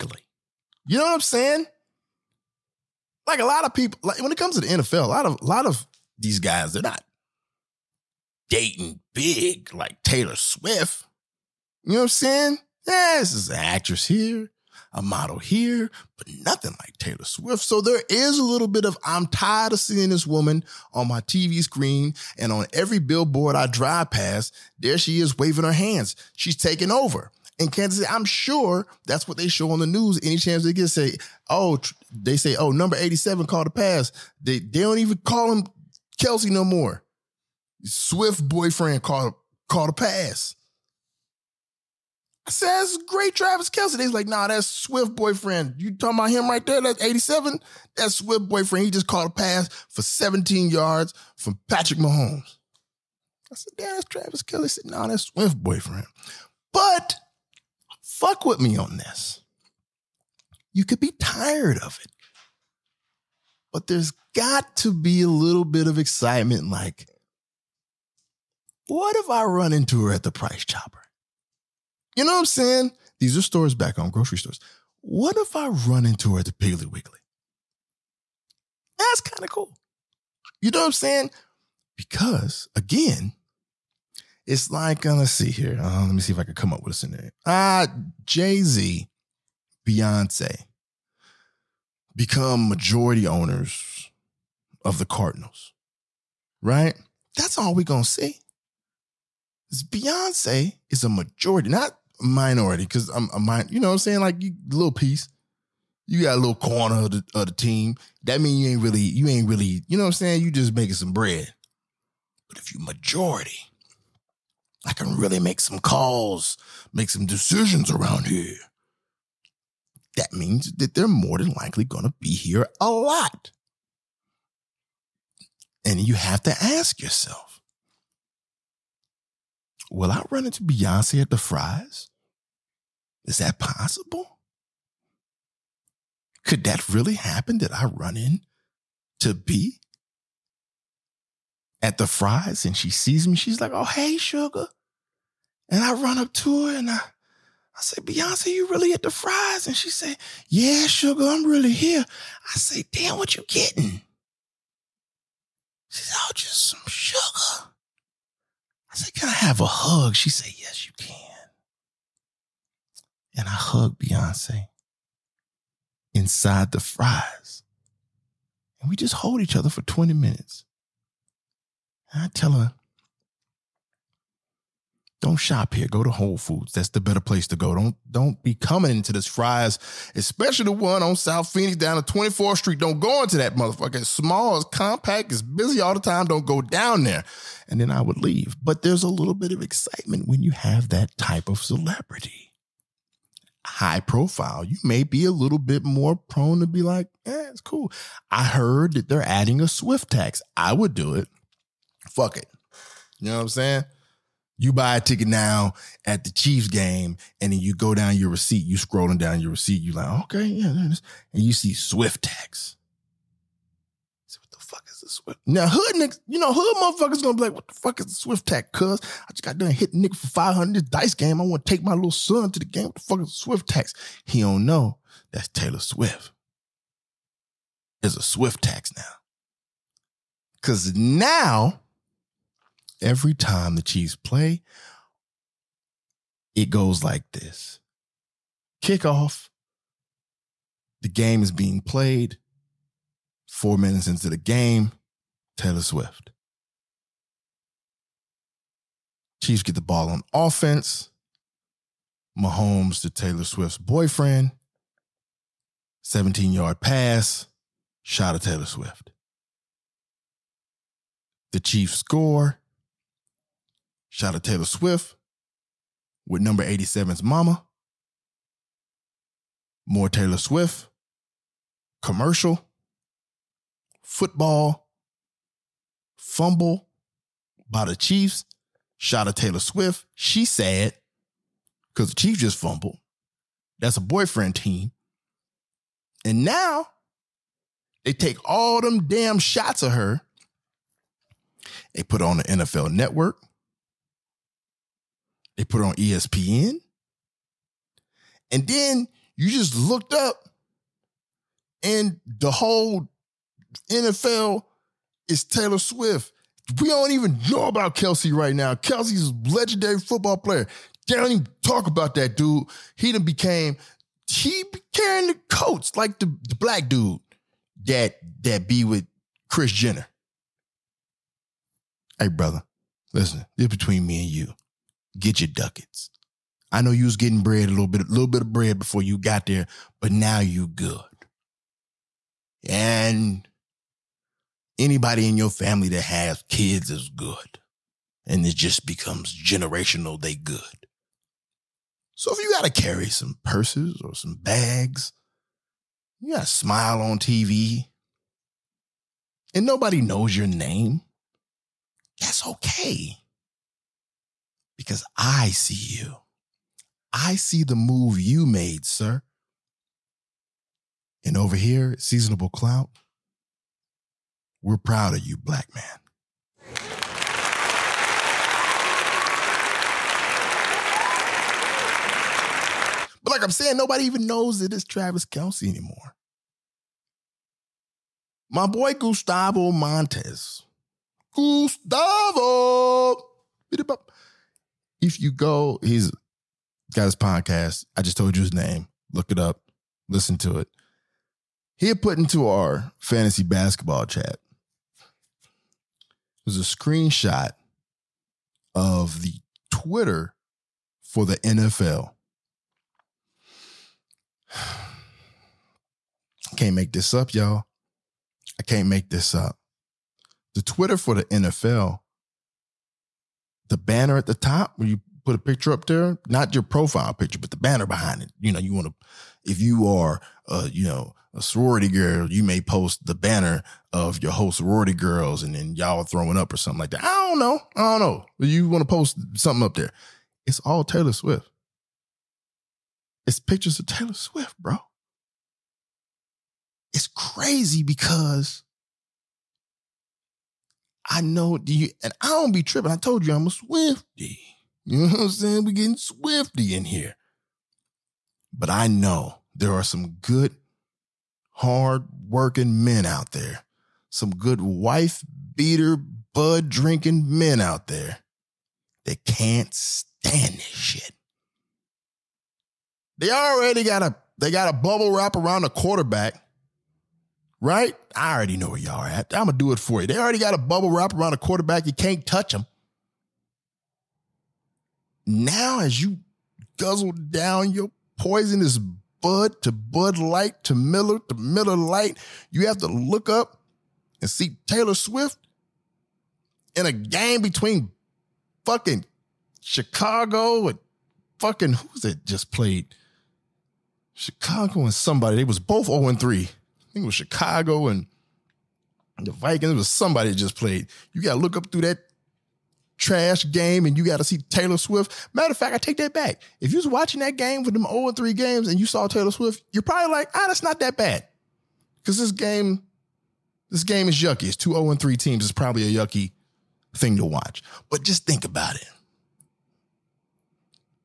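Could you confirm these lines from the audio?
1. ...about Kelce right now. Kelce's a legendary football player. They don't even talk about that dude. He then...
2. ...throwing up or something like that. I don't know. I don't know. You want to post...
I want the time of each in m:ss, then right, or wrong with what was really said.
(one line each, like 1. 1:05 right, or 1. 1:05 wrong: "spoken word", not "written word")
1. 5:07 right
2. 7:06 right.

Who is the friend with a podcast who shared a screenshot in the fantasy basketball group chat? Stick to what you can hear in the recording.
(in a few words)
Gustavo Montes.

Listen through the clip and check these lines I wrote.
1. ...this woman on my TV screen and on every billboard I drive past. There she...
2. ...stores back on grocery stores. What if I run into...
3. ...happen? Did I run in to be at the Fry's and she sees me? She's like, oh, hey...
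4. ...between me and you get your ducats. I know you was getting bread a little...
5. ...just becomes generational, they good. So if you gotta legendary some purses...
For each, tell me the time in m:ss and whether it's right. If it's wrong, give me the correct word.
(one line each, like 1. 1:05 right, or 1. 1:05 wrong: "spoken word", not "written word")
1. 0:20 right
2. 1:13 right
3. 2:17 right
4. 5:23 right
5. 5:38 wrong: "carry", not "legendary".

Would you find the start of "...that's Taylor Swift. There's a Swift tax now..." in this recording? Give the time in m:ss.
3:45.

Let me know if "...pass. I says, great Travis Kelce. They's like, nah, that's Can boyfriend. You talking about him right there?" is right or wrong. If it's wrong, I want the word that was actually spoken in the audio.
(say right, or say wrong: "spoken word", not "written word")
wrong: "Swift", not "Can".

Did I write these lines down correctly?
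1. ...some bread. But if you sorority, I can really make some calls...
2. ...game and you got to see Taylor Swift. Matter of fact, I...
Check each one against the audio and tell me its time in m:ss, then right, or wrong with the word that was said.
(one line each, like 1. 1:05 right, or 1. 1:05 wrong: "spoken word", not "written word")
1. 1:50 wrong: "majority", not "sorority"
2. 8:23 right.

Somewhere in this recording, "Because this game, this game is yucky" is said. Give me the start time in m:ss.
8:31.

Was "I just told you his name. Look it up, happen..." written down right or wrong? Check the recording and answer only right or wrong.
wrong.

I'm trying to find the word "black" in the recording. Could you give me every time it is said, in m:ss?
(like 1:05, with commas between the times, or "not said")
5:16, 6:05.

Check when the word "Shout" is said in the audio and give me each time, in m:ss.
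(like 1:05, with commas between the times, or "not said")
4:24, 4:38.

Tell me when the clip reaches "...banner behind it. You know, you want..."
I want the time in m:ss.
6:57.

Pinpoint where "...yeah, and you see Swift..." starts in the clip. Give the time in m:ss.
3:30.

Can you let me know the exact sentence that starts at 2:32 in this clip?
I say, damn, what you getting?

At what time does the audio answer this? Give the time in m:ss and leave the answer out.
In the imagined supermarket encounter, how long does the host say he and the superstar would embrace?
2:49.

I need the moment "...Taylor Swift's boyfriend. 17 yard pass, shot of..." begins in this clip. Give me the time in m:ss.
4:13.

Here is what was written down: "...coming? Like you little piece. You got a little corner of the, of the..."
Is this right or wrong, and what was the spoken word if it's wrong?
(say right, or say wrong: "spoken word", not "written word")
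wrong: "saying", not "coming".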